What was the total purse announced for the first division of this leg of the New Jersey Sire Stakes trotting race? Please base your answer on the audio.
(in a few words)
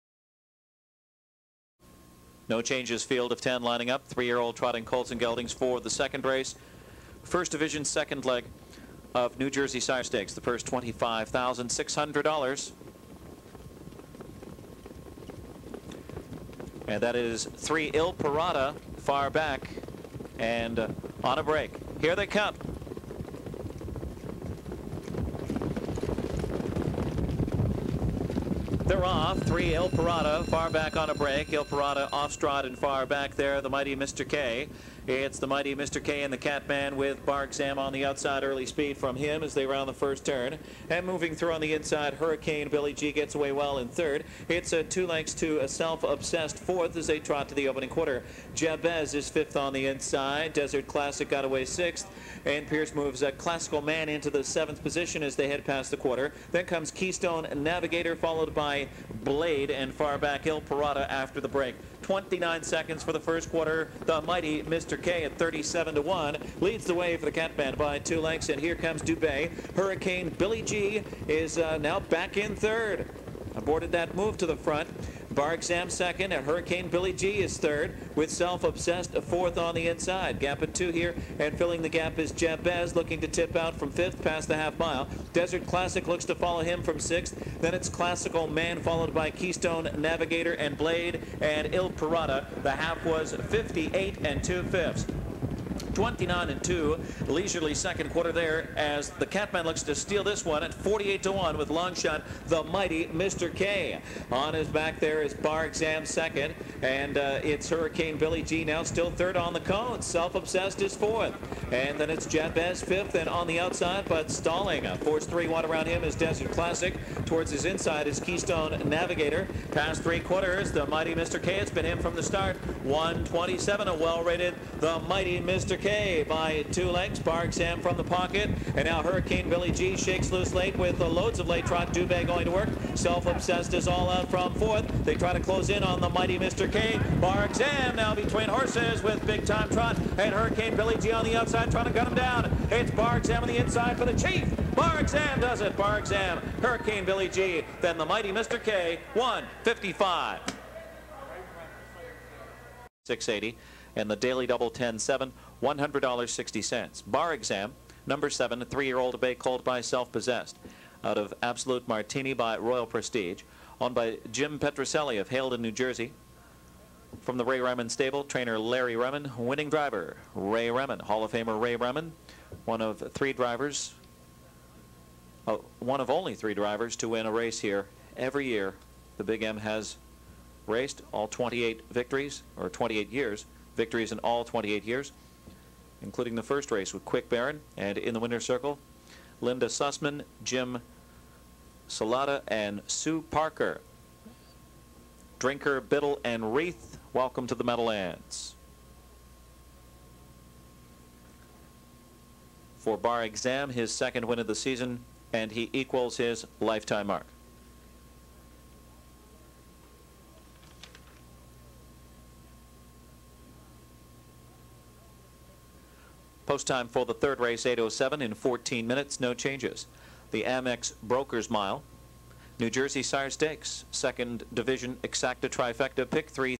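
$25,600.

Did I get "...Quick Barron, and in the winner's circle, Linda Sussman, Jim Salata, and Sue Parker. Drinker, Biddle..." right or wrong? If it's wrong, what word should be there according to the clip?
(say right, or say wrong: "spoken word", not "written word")
right.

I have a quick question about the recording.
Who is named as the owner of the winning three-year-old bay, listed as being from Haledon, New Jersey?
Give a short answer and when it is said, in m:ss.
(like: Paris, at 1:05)
Jim Petroselli, at 2:44.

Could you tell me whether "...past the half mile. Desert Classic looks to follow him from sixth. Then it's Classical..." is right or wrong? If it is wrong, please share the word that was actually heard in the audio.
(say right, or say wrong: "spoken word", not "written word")
right.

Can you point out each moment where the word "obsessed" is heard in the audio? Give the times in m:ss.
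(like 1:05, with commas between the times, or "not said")
0:45, 1:18, 1:50, 2:12.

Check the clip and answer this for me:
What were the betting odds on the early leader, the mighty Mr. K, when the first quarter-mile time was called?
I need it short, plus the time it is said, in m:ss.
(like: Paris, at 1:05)
37 to 1, at 1:05.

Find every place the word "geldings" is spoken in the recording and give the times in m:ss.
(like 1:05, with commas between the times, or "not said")
0:05.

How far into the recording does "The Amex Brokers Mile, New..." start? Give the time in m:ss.
3:40.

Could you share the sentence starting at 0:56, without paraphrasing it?
Then comes Keystone Navigator, followed by Blade and far back Hill Parada after the break.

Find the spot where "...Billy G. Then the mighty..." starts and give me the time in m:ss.
2:27.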